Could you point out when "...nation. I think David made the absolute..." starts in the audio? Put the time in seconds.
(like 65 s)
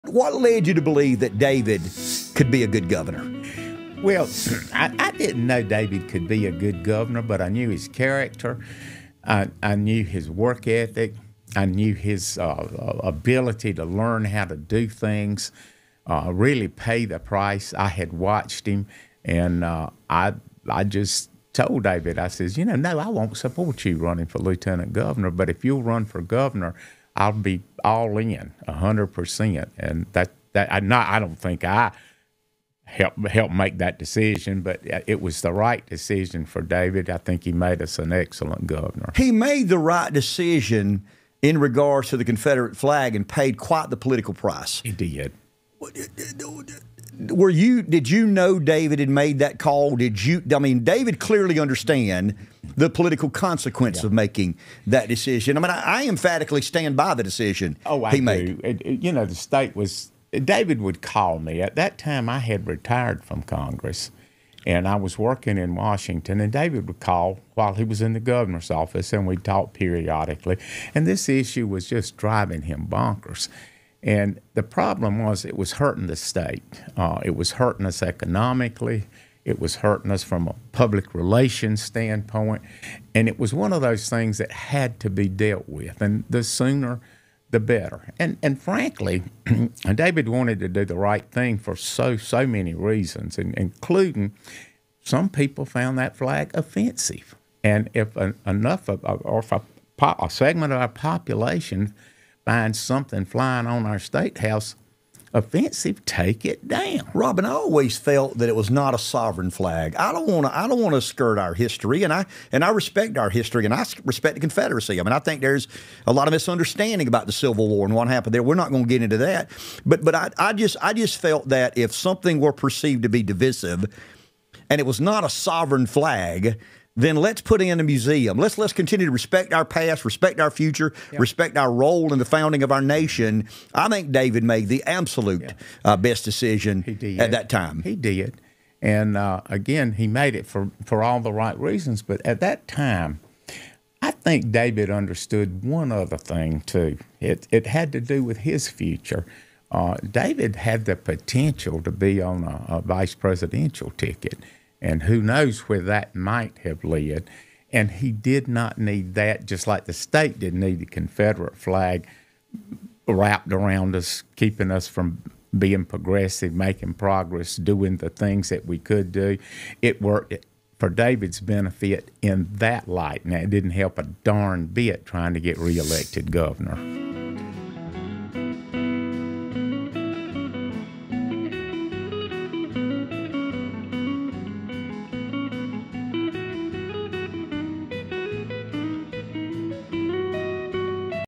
132 s.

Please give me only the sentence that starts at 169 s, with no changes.
It worked for David's benefit in that light.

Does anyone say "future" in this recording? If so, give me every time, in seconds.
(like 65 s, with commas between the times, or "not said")
130 s, 148 s.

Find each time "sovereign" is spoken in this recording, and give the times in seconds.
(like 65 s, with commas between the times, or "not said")
108 s, 125 s.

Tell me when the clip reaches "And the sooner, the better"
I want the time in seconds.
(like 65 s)
86 s.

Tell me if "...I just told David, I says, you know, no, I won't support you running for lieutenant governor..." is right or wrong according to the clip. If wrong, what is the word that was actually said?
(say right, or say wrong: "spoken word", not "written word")
right.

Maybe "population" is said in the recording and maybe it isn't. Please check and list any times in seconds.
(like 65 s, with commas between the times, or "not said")
100 s.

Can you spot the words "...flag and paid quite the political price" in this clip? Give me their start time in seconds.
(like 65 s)
42 s.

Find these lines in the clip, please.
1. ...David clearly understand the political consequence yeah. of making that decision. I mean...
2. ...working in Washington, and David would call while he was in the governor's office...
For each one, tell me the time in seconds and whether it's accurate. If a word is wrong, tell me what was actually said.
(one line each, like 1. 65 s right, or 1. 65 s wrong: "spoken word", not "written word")
1. 50 s right
2. 65 s right.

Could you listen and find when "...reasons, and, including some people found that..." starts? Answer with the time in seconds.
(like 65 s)
92 s.